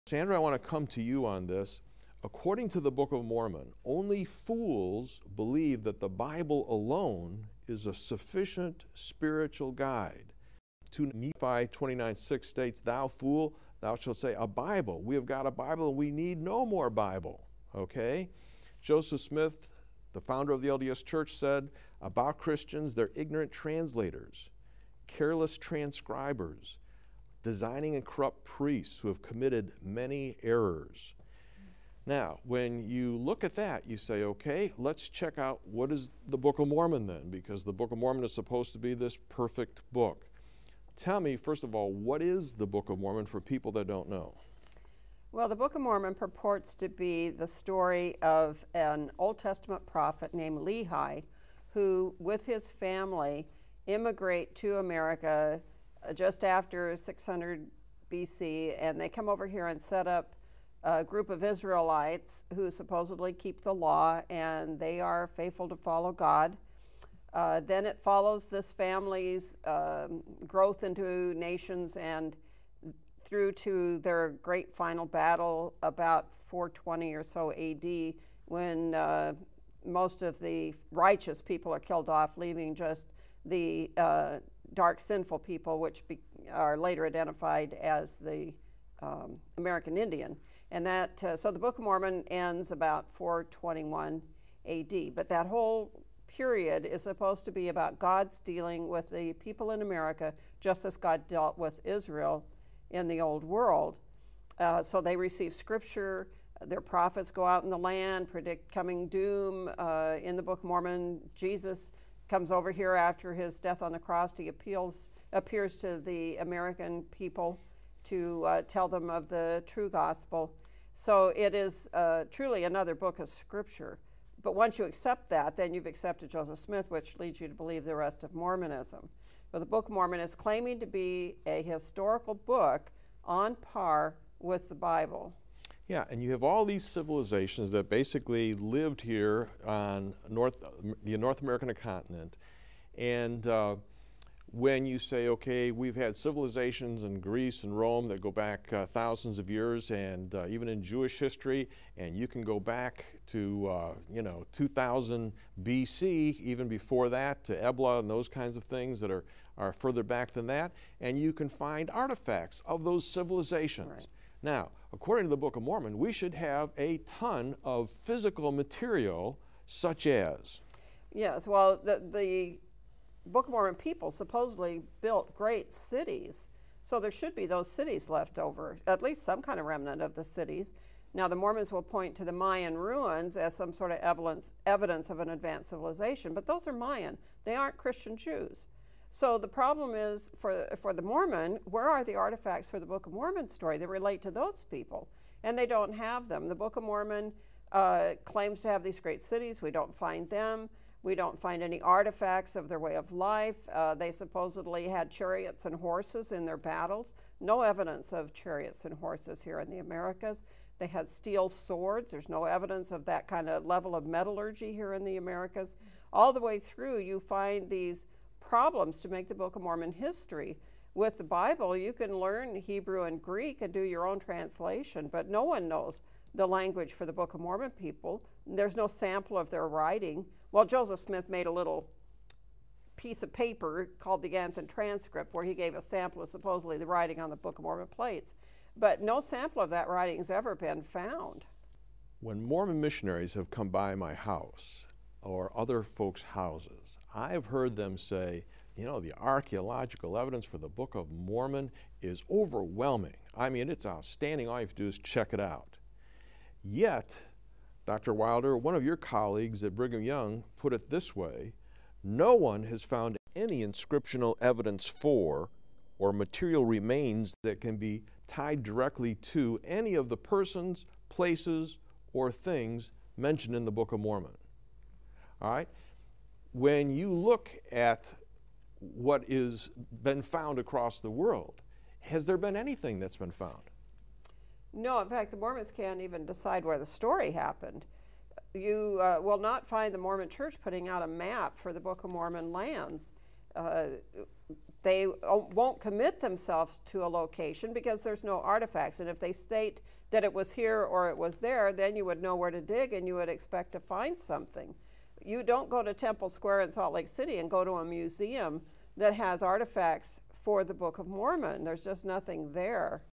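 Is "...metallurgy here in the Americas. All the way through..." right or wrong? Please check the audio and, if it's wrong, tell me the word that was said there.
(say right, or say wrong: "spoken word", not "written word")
right.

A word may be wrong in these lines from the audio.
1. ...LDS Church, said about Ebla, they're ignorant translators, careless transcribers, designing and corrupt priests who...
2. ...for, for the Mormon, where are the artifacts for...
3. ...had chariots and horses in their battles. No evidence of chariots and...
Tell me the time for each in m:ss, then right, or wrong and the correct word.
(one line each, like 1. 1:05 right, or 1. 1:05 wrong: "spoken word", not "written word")
1. 0:20 wrong: "Christians", not "Ebla"
2. 3:10 right
3. 3:24 right.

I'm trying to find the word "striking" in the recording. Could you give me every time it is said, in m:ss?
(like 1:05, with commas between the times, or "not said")
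not said.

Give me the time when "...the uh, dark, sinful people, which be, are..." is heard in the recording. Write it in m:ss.
1:23.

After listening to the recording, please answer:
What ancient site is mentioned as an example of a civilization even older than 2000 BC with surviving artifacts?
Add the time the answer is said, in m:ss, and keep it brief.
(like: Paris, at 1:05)
Ebla, at 2:37.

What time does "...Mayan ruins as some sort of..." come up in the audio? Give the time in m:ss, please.
3:02.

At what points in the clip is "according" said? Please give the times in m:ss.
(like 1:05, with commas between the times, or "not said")
0:02, 2:44.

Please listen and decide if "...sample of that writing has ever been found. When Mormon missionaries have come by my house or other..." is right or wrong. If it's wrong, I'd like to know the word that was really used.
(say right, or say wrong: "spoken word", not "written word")
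right.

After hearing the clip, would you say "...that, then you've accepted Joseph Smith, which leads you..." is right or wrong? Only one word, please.
right.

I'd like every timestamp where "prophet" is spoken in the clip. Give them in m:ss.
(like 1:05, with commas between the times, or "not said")
0:49, 1:46.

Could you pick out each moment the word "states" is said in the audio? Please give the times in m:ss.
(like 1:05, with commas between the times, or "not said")
0:12, 4:59.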